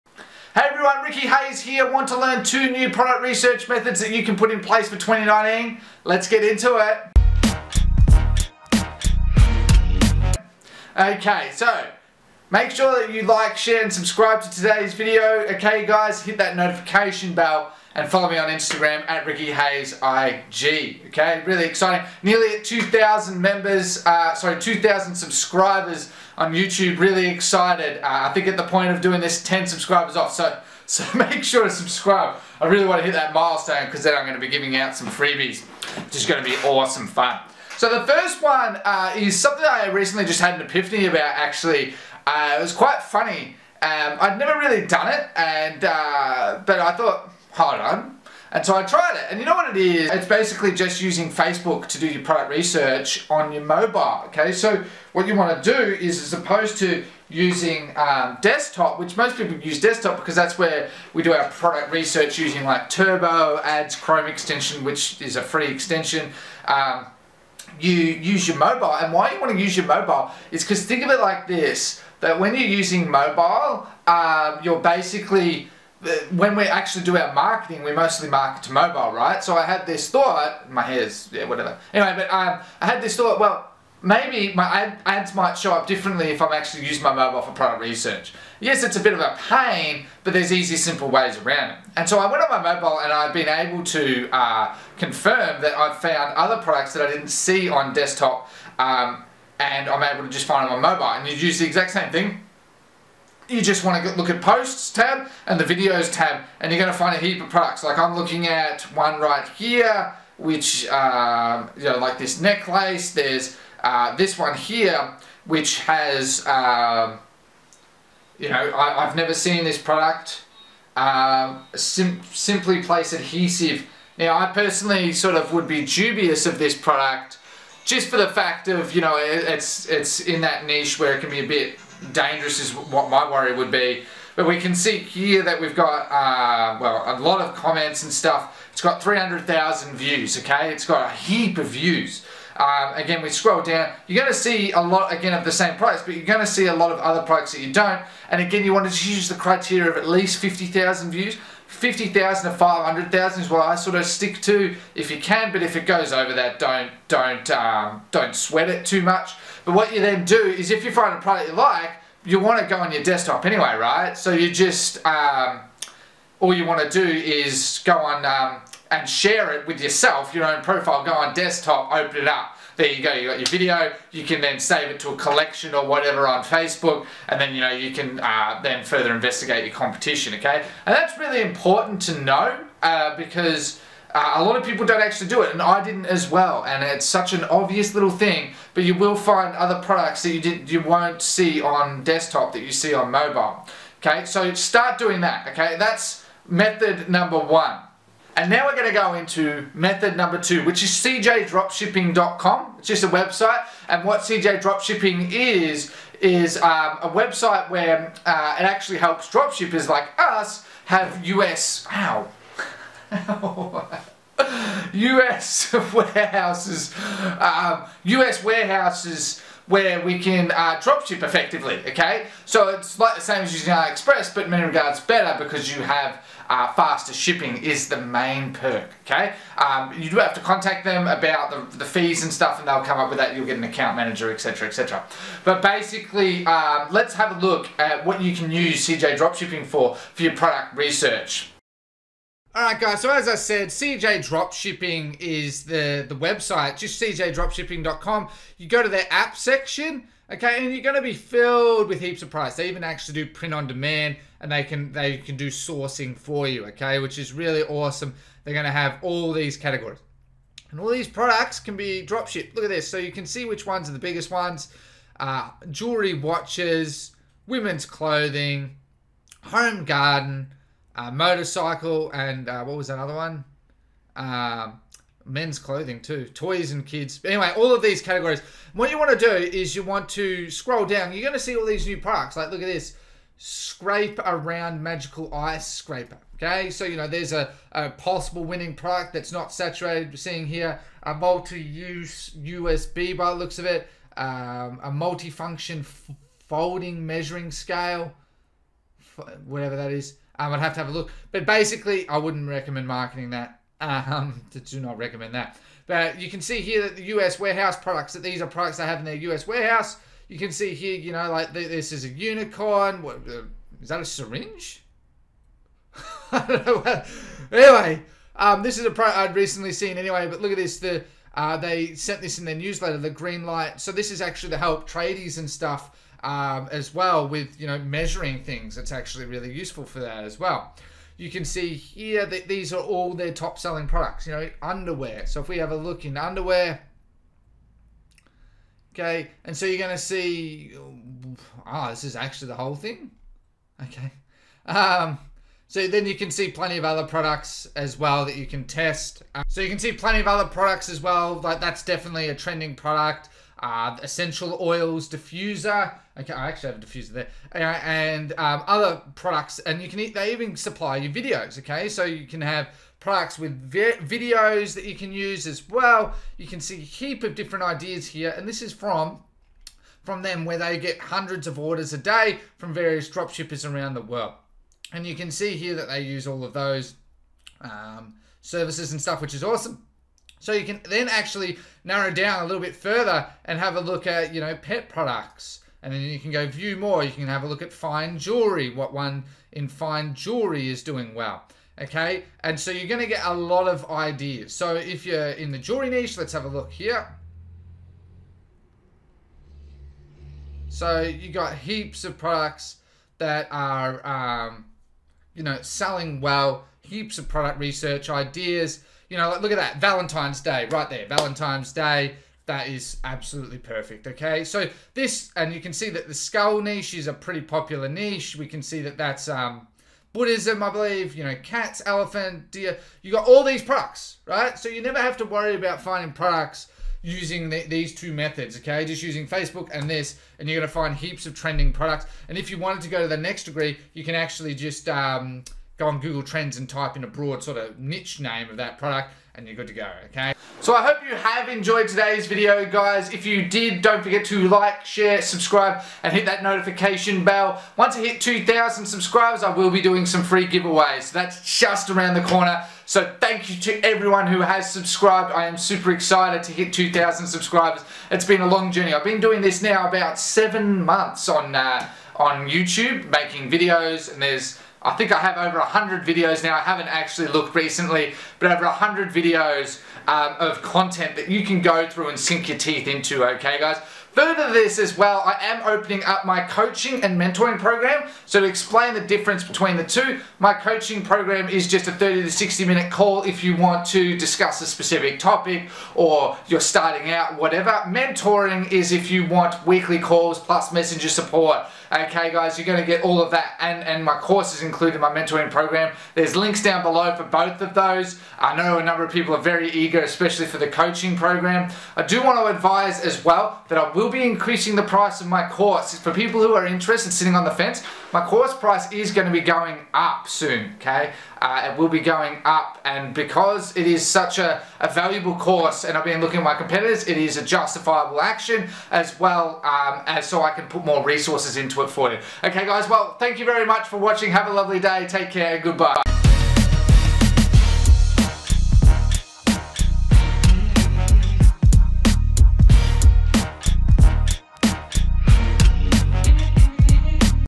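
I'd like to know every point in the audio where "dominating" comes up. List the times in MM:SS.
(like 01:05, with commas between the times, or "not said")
not said.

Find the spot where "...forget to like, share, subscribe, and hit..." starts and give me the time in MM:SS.
07:24.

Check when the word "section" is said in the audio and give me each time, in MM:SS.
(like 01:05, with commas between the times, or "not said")
04:09.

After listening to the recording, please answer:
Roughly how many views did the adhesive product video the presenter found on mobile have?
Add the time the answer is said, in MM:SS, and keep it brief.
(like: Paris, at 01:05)
300,000, at 02:19.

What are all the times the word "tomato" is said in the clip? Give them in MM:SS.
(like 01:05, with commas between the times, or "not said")
not said.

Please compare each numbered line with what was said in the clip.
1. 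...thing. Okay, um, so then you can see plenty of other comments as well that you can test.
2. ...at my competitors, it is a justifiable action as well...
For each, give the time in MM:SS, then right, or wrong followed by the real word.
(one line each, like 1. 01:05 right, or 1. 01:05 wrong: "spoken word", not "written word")
1. 05:42 wrong: "products", not "comments"
2. 08:36 right.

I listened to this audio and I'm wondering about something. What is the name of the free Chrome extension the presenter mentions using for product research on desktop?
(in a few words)
Turbo Ads.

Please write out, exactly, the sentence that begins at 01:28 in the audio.
Yes, it's a bit of a pain, but there's easy, simple ways around it.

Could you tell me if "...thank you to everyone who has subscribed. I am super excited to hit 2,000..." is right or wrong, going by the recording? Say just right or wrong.
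right.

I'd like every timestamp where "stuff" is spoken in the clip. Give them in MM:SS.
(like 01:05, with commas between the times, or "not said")
02:18, 03:52, 05:25, 06:19.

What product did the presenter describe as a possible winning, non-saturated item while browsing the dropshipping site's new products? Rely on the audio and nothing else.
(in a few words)
Magical ice scraper.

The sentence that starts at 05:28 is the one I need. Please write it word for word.
It's actually really useful for that as well.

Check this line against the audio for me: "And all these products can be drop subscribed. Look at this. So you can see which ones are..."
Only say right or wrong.
wrong.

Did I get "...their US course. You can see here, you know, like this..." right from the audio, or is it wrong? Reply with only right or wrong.
wrong.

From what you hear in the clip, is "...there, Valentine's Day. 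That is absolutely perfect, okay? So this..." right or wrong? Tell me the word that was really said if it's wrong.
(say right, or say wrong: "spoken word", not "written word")
right.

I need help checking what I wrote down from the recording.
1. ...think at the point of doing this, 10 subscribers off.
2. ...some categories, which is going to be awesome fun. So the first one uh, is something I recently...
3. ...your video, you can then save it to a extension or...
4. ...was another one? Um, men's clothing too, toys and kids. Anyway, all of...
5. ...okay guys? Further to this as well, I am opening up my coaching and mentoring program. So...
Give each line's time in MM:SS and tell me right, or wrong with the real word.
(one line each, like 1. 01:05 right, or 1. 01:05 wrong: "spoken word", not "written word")
1. 00:28 right
2. 00:34 wrong: "freebies", not "categories"
3. 02:53 wrong: "collection", not "extension"
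4. 04:32 right
5. 07:53 right.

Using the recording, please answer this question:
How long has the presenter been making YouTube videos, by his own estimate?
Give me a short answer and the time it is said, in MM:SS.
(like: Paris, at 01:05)
About seven months, at 07:39.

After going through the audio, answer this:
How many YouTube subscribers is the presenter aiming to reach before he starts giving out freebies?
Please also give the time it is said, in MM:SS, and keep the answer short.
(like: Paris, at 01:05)
2,000, at 00:24.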